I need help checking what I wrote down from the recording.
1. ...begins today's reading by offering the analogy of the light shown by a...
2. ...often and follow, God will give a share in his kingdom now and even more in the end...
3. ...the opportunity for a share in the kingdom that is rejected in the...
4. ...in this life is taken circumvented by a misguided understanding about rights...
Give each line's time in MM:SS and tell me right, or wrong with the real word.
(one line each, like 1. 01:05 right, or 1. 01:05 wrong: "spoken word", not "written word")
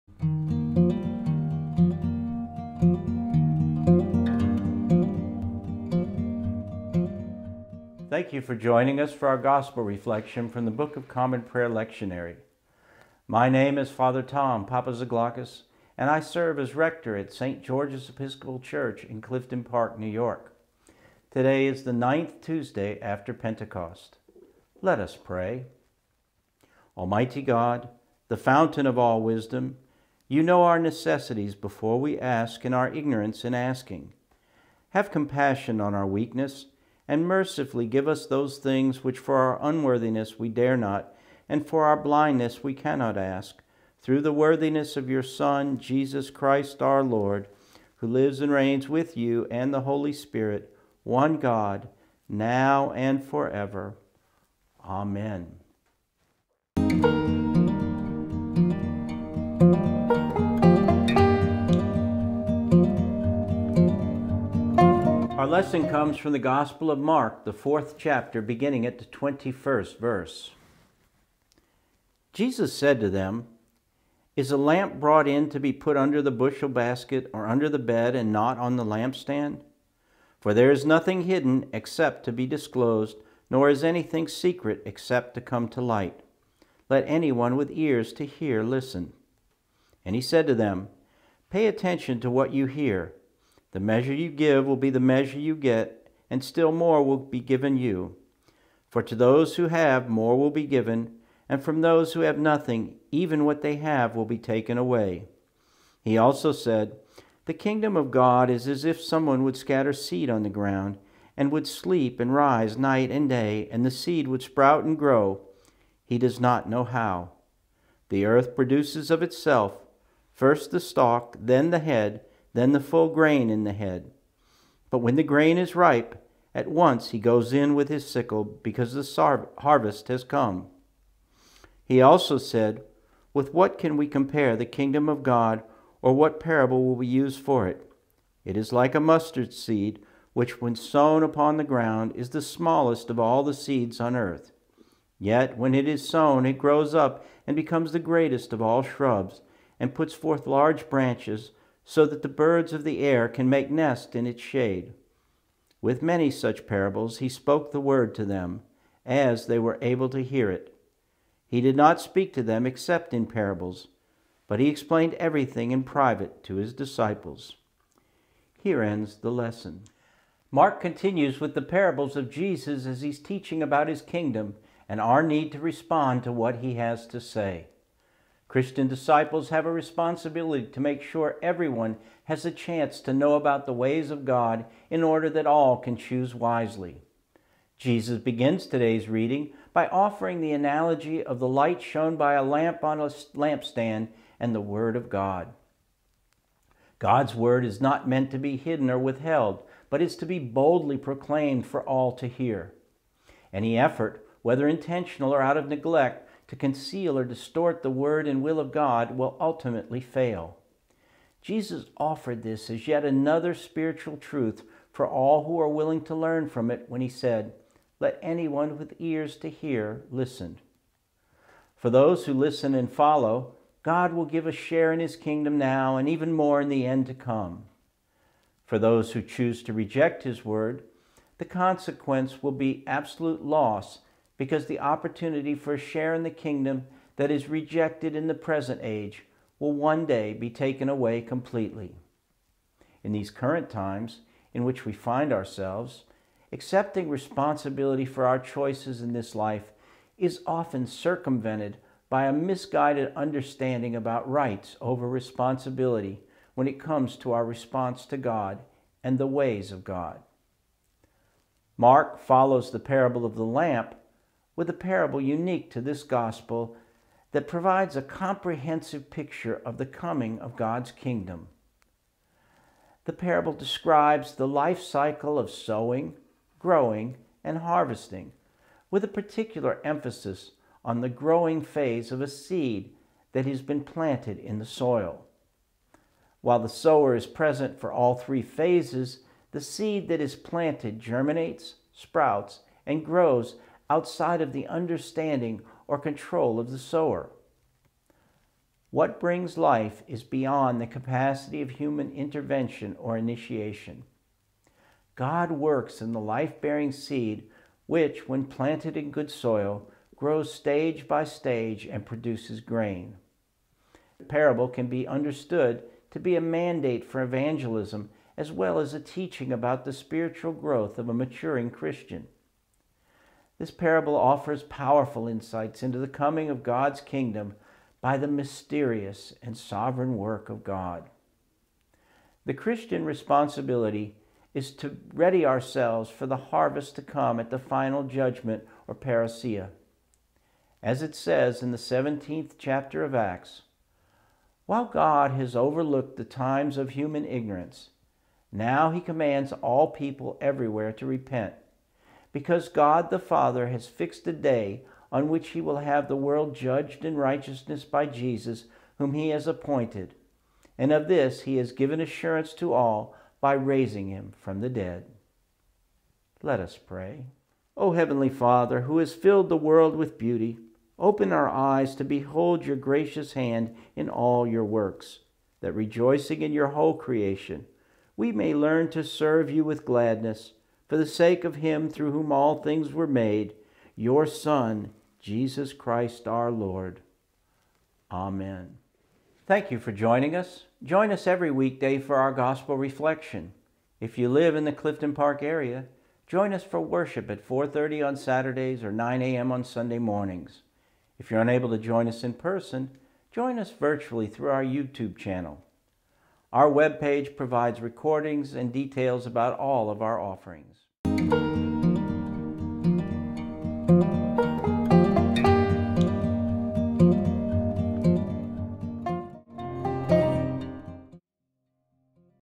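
1. 03:08 right
2. 03:42 wrong: "listen", not "often"
3. 03:54 right
4. 04:08 wrong: "often", not "taken".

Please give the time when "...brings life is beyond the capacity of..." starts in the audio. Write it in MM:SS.
04:59.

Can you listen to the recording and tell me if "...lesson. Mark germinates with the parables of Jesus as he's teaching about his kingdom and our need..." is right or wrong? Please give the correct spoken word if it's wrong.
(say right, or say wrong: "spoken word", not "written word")
wrong: "continues", not "germinates".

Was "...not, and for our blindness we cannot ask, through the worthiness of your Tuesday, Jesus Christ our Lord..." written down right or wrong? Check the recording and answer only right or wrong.
wrong.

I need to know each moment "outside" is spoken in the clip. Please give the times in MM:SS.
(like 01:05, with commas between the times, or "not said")
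04:53.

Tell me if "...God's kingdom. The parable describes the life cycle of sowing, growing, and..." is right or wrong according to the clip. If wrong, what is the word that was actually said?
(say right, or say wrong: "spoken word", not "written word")
right.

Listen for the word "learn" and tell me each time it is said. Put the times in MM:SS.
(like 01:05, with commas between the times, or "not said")
03:36, 06:18.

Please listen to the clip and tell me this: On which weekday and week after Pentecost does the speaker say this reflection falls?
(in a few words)
Ninth Tuesday.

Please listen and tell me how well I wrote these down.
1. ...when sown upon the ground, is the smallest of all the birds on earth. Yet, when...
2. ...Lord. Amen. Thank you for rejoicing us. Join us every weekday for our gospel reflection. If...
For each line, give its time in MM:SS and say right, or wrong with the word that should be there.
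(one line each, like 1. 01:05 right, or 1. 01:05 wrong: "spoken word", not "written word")
1. 02:20 wrong: "seeds", not "birds"
2. 06:26 wrong: "joining", not "rejoicing".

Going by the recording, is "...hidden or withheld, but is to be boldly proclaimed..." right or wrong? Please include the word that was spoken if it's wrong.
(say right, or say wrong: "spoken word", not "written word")
right.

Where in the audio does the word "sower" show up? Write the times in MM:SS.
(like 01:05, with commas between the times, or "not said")
04:46, 04:56.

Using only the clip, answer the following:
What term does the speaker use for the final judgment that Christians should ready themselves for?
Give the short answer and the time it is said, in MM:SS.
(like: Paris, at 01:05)
Parousia, at 05:38.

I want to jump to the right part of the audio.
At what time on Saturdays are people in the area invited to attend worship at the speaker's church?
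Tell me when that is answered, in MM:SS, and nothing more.
06:37.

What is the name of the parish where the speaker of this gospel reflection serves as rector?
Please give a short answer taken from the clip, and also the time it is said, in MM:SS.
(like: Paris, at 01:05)
St. George's Episcopal Church, at 00:17.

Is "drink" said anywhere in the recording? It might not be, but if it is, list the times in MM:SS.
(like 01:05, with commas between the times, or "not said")
not said.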